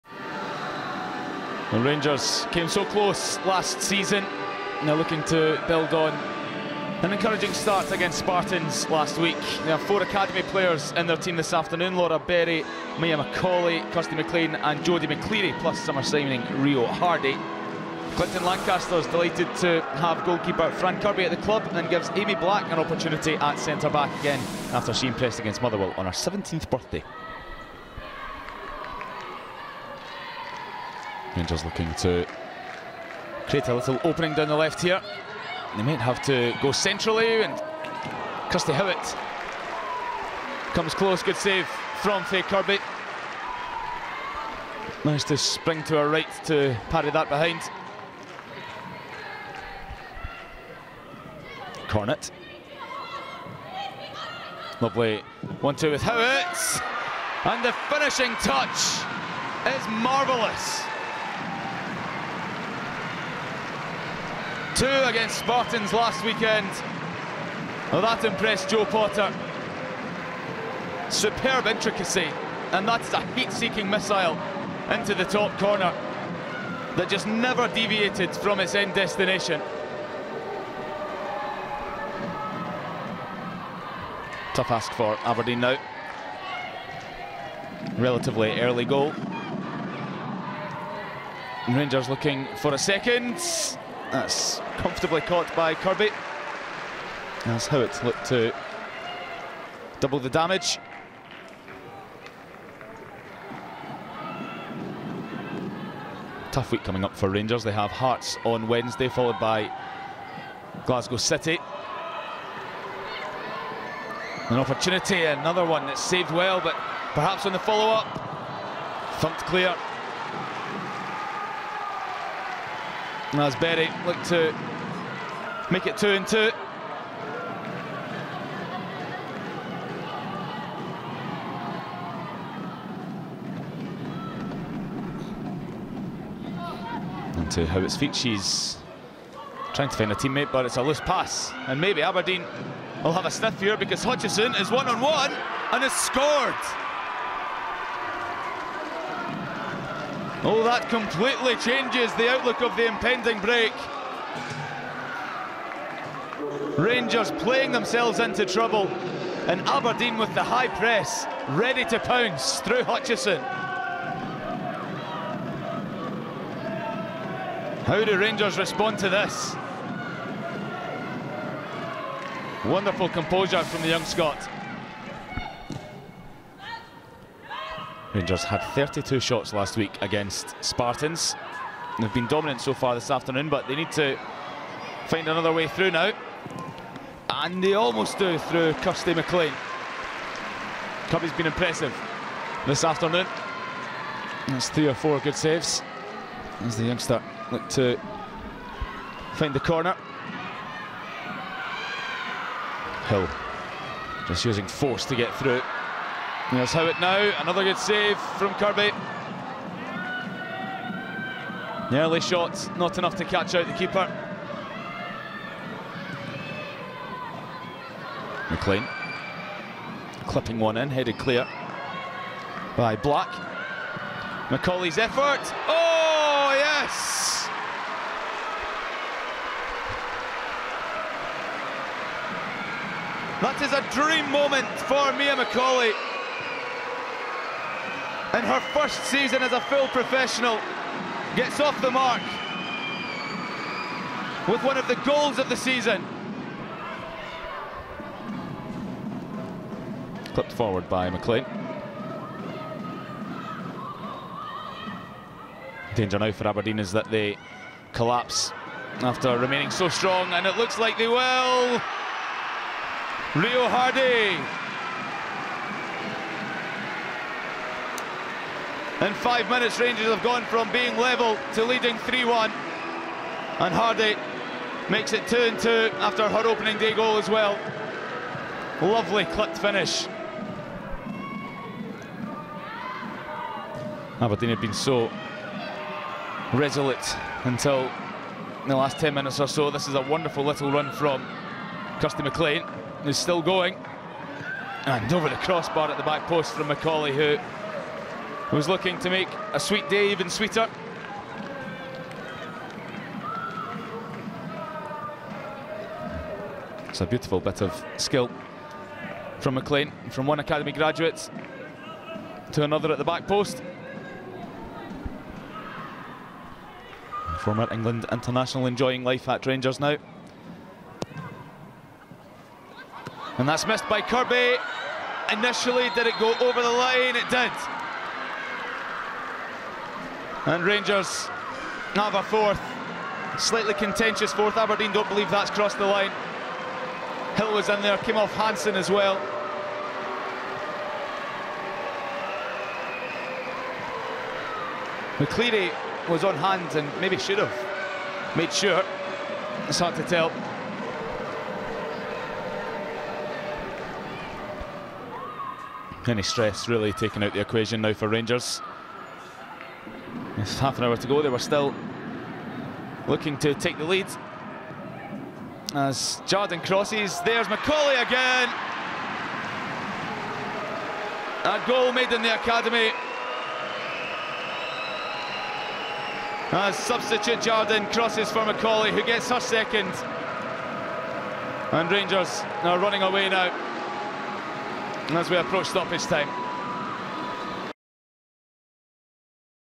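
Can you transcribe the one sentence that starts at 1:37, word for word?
That's how it looked to double the damage.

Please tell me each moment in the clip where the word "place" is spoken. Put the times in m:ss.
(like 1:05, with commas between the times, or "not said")
not said.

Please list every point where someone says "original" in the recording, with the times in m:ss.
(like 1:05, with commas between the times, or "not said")
not said.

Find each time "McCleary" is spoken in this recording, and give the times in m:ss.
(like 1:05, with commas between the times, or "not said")
0:15, 5:45.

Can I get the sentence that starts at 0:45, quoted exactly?
Managed to spring to her right to parry that behind.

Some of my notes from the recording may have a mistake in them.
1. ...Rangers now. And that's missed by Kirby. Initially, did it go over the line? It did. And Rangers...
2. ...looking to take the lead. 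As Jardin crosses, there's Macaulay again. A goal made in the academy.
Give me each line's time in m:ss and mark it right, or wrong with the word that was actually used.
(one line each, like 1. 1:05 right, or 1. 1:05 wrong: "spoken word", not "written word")
1. 5:19 right
2. 6:03 right.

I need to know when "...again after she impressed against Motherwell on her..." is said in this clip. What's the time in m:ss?
0:24.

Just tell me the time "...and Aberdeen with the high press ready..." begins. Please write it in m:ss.
2:39.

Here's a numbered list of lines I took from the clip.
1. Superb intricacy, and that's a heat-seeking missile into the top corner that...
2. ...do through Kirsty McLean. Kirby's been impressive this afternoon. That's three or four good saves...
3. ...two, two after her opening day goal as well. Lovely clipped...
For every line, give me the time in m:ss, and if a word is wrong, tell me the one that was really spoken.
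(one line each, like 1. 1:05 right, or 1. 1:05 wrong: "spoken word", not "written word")
1. 1:11 right
2. 3:08 right
3. 4:35 right.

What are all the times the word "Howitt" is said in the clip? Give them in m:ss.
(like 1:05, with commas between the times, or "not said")
0:38, 0:56, 2:17, 3:26.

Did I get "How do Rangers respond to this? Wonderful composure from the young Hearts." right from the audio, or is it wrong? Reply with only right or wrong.
wrong.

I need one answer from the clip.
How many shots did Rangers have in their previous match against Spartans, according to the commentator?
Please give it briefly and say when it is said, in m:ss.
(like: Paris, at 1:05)
32, at 2:58.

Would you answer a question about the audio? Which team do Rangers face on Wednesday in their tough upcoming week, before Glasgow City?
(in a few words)
Hearts.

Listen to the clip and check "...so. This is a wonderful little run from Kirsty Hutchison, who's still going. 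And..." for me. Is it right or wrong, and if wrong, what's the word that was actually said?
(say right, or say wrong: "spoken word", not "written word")
wrong: "McLean", not "Hutchison".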